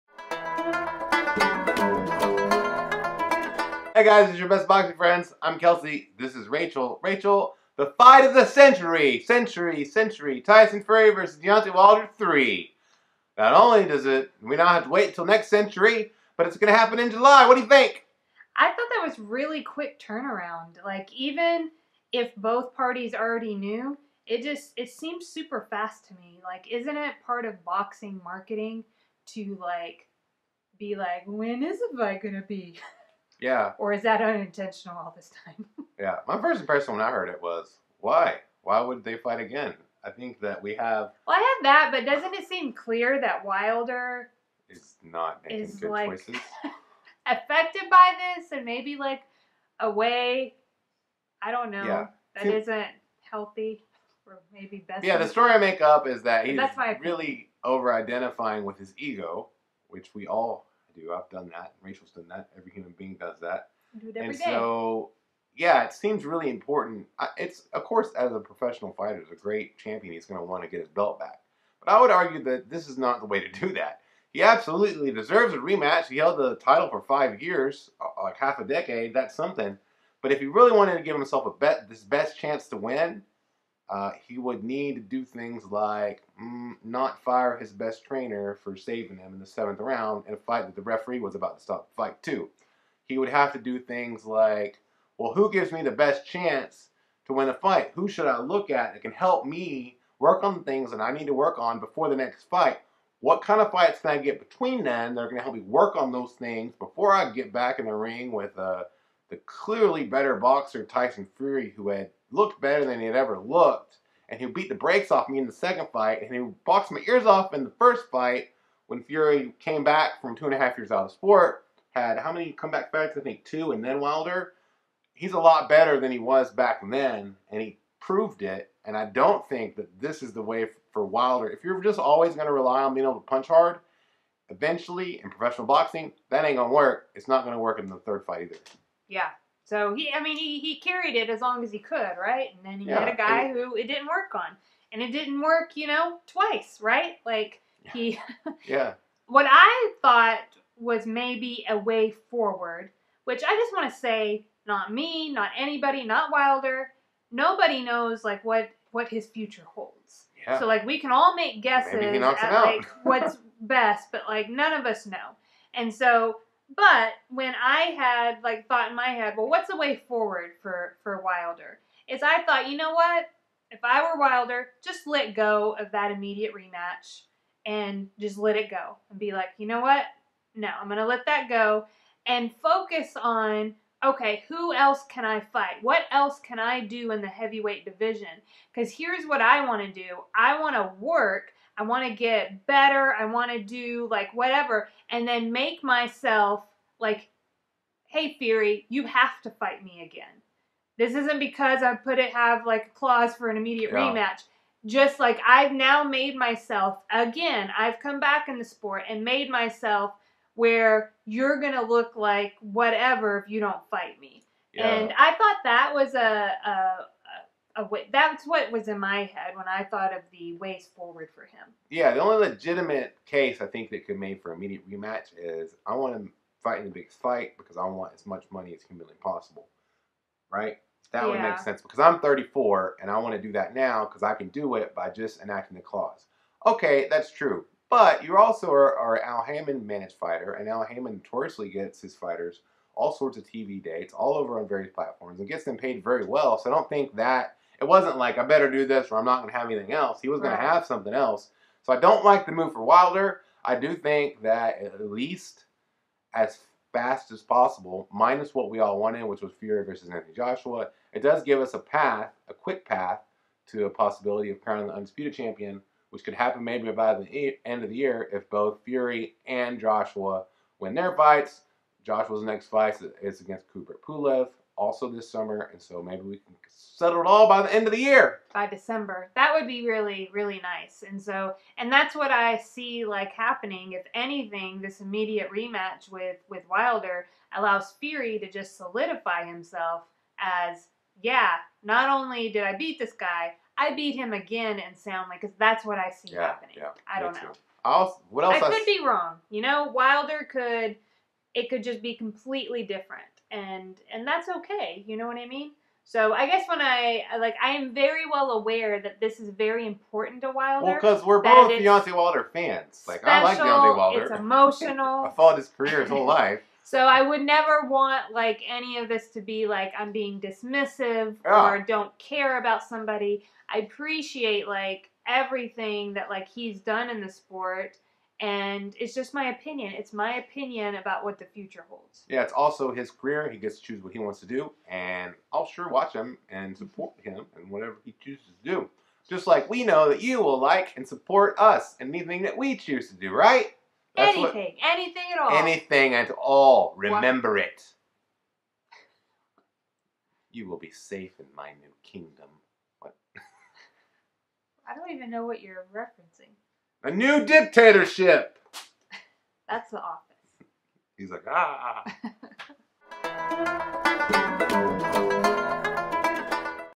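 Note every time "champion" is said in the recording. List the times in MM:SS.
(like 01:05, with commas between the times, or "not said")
01:09, 04:25.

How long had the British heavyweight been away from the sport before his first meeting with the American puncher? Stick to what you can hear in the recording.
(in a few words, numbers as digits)
2.5 years.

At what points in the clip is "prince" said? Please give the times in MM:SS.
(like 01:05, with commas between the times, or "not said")
not said.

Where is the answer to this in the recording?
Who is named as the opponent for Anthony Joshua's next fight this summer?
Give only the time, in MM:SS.
04:33.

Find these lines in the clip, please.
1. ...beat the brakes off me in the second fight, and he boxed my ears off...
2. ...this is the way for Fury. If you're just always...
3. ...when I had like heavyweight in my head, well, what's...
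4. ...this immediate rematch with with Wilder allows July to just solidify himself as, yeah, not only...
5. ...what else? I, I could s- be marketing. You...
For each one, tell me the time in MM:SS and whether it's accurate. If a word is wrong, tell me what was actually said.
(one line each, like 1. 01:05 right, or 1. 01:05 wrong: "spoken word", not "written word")
1. 01:54 right
2. 02:10 wrong: "Wilder", not "Fury"
3. 02:47 wrong: "thought", not "heavyweight"
4. 04:44 wrong: "Fury", not "July"
5. 04:58 wrong: "wrong", not "marketing".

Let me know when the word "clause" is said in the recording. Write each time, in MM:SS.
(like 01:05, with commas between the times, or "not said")
03:22, 03:55.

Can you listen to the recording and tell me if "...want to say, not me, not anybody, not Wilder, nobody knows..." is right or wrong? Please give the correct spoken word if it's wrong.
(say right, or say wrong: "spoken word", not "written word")
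right.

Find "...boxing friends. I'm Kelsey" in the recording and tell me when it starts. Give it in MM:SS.
00:04.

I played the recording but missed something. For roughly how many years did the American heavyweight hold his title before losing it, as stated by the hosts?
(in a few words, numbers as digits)
5 years.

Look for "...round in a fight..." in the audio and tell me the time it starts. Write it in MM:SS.
01:29.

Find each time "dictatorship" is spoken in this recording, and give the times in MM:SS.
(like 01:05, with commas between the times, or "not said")
05:57.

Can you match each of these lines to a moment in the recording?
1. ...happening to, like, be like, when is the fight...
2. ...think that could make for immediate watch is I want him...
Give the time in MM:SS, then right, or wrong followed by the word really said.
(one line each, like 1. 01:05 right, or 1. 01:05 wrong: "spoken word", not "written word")
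1. 00:28 wrong: "marketing", not "happening"
2. 03:43 wrong: "rematch", not "watch".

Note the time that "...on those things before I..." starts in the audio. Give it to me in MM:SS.
01:45.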